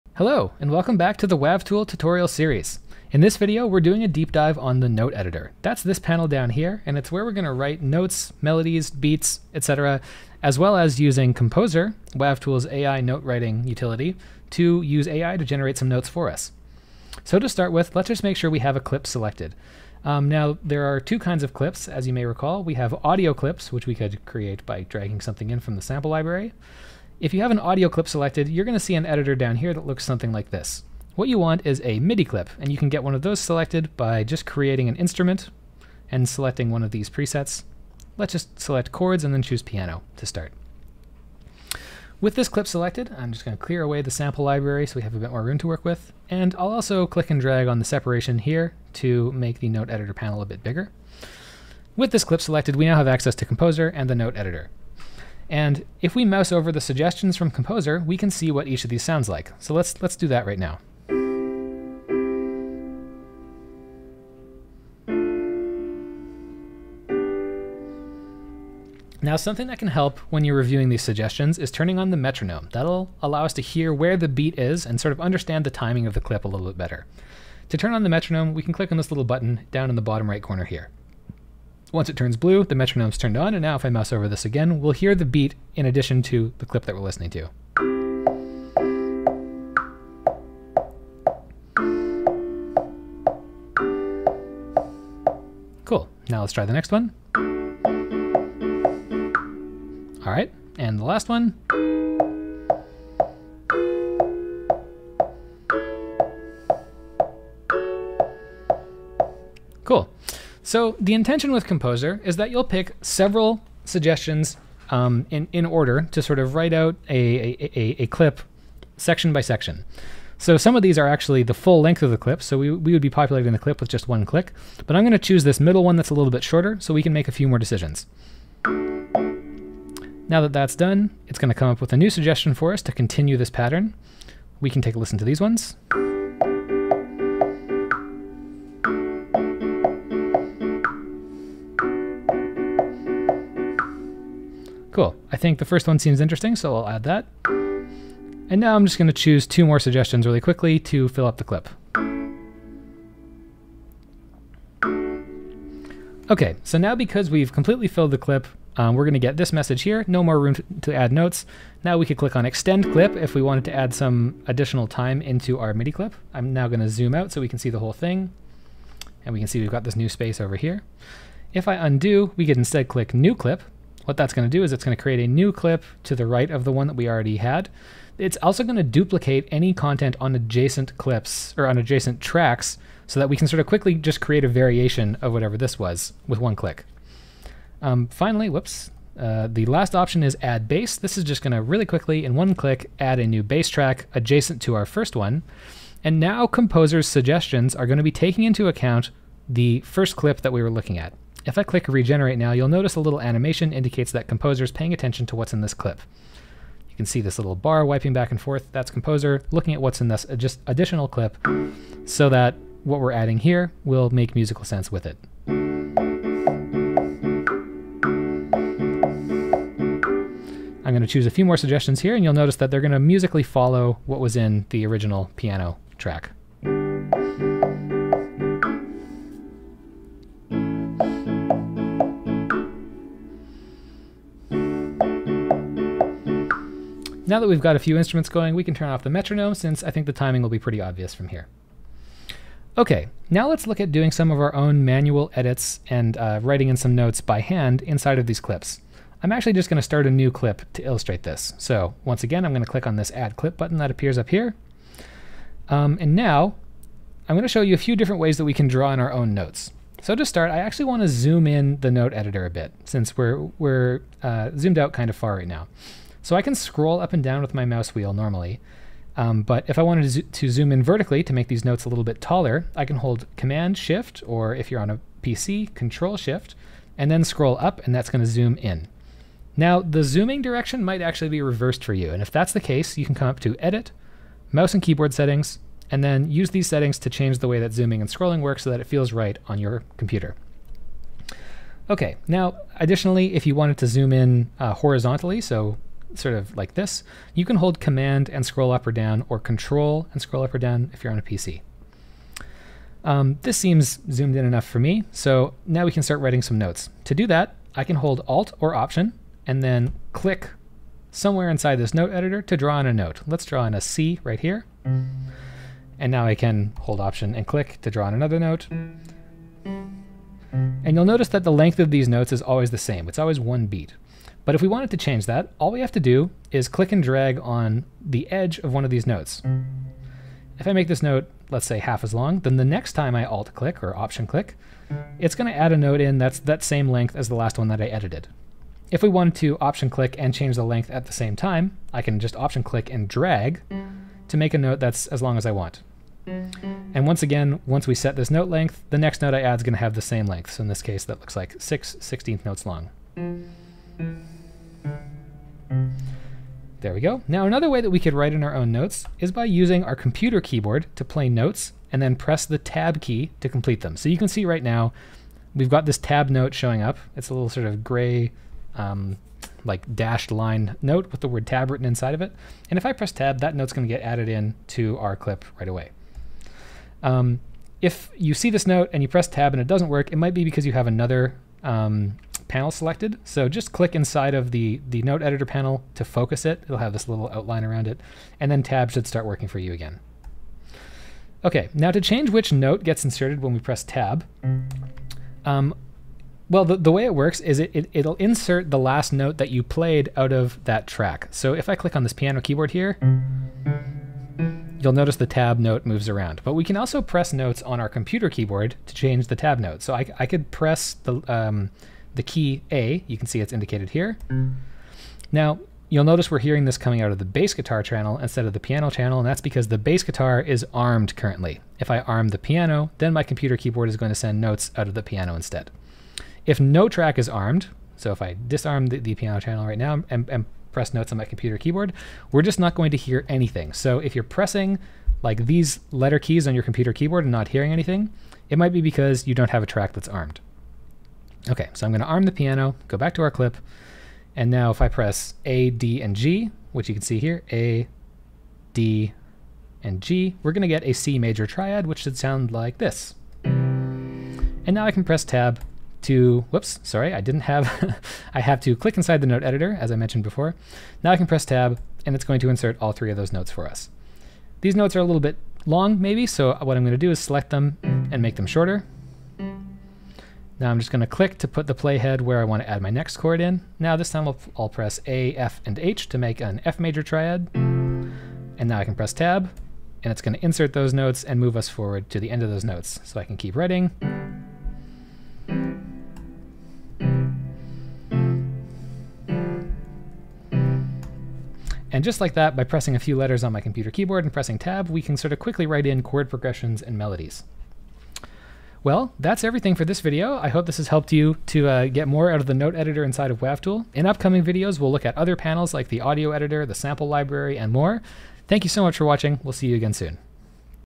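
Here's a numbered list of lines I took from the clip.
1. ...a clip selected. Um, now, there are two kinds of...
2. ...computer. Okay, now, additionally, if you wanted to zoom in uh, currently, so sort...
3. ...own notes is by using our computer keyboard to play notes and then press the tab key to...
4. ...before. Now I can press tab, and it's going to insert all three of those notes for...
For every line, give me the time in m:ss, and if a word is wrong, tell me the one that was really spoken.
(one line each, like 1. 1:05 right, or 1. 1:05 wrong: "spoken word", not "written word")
1. 0:18 right
2. 4:49 wrong: "horizontally", not "currently"
3. 5:58 right
4. 7:40 right.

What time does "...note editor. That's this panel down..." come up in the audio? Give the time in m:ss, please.
0:04.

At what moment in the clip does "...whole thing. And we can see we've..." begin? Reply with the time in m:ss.
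2:47.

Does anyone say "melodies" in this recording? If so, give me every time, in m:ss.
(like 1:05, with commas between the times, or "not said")
0:08, 8:16.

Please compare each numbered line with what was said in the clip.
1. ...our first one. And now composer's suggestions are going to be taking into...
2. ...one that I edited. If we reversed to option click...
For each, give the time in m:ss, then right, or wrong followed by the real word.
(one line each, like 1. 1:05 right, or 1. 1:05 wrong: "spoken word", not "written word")
1. 3:14 right
2. 5:37 wrong: "wanted", not "reversed".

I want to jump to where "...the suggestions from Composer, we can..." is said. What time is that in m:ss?
0:56.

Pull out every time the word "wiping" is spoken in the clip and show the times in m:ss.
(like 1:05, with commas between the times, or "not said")
3:27.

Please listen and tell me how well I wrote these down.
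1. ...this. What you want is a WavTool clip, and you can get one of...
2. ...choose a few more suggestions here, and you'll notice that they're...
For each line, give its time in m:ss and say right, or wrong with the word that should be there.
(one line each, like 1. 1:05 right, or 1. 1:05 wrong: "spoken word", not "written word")
1. 0:30 wrong: "MIDI", not "WavTool"
2. 3:41 right.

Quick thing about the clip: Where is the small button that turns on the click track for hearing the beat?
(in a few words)
bottom right corner.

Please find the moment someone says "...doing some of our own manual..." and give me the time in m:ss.
4:03.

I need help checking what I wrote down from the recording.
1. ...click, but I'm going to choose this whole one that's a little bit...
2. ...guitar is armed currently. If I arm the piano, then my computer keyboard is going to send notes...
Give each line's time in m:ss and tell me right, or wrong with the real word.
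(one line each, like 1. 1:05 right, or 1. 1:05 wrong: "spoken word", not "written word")
1. 2:04 wrong: "middle", not "whole"
2. 7:00 right.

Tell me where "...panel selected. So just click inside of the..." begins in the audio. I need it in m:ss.
6:22.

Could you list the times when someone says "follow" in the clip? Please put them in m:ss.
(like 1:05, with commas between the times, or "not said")
3:43.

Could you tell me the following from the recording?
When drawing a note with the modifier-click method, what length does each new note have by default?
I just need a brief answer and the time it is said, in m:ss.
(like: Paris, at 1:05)
One beat, at 5:23.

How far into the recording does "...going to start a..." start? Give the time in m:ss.
4:09.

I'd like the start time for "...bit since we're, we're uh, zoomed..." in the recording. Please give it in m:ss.
4:22.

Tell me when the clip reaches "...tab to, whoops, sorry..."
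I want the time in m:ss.
7:35.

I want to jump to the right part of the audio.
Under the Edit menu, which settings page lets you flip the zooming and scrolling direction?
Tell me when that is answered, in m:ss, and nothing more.
4:44.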